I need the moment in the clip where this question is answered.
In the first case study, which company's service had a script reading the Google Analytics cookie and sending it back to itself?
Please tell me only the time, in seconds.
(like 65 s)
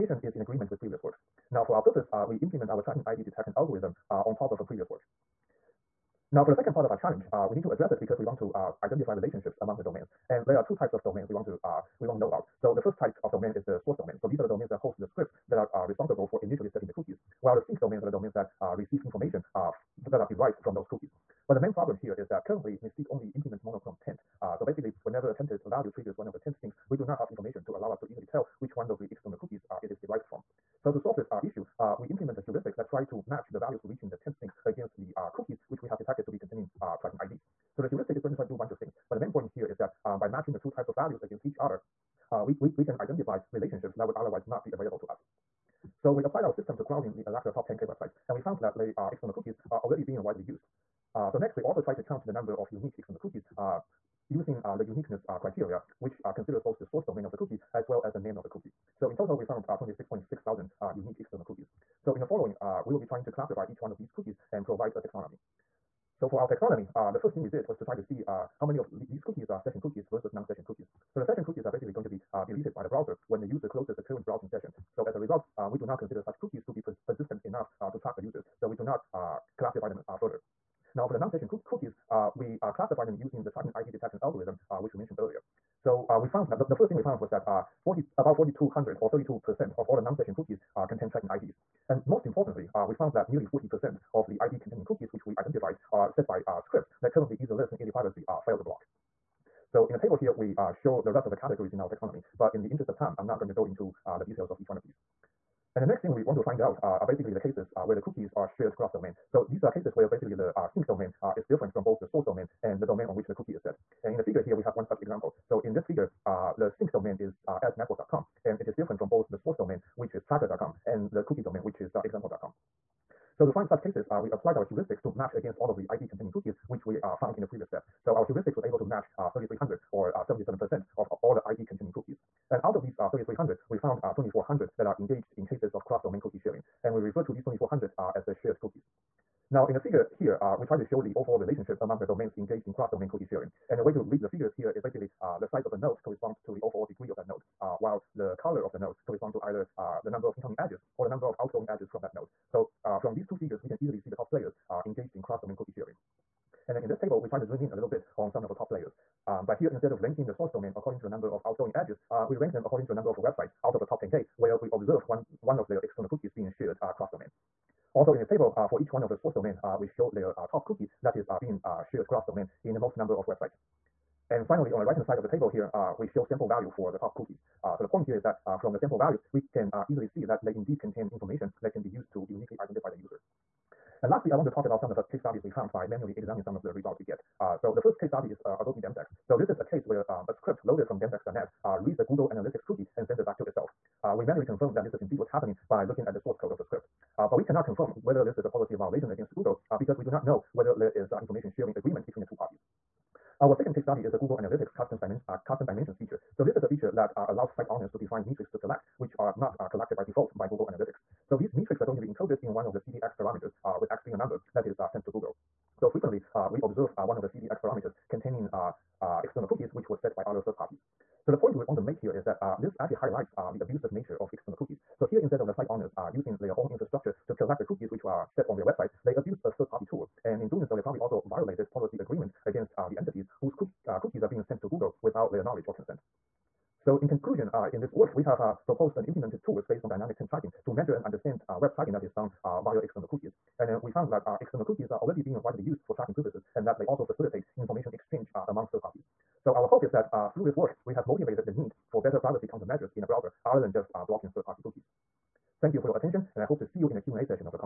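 188 s.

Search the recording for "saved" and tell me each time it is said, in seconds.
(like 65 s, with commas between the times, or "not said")
not said.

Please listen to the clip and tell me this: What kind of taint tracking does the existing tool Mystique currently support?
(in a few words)
Monochrome taint.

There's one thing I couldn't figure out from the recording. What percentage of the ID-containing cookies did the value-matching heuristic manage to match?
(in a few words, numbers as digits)
77%.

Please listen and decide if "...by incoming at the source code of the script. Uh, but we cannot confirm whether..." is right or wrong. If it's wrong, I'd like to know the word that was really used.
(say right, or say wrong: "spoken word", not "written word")
wrong: "looking", not "incoming".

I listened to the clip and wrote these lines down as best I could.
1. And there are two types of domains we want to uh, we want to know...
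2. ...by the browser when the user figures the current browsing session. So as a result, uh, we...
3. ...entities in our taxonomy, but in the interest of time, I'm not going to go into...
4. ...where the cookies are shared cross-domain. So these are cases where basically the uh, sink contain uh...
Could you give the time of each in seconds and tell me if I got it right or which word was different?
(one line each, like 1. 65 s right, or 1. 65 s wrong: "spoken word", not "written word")
1. 10 s right
2. 72 s wrong: "closes", not "figures"
3. 101 s wrong: "categories", not "entities"
4. 107 s wrong: "domain", not "contain".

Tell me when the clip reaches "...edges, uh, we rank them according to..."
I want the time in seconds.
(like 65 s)
161 s.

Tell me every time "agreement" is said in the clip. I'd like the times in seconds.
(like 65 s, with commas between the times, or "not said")
0 s, 201 s, 231 s.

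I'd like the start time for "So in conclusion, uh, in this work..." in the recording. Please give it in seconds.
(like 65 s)
236 s.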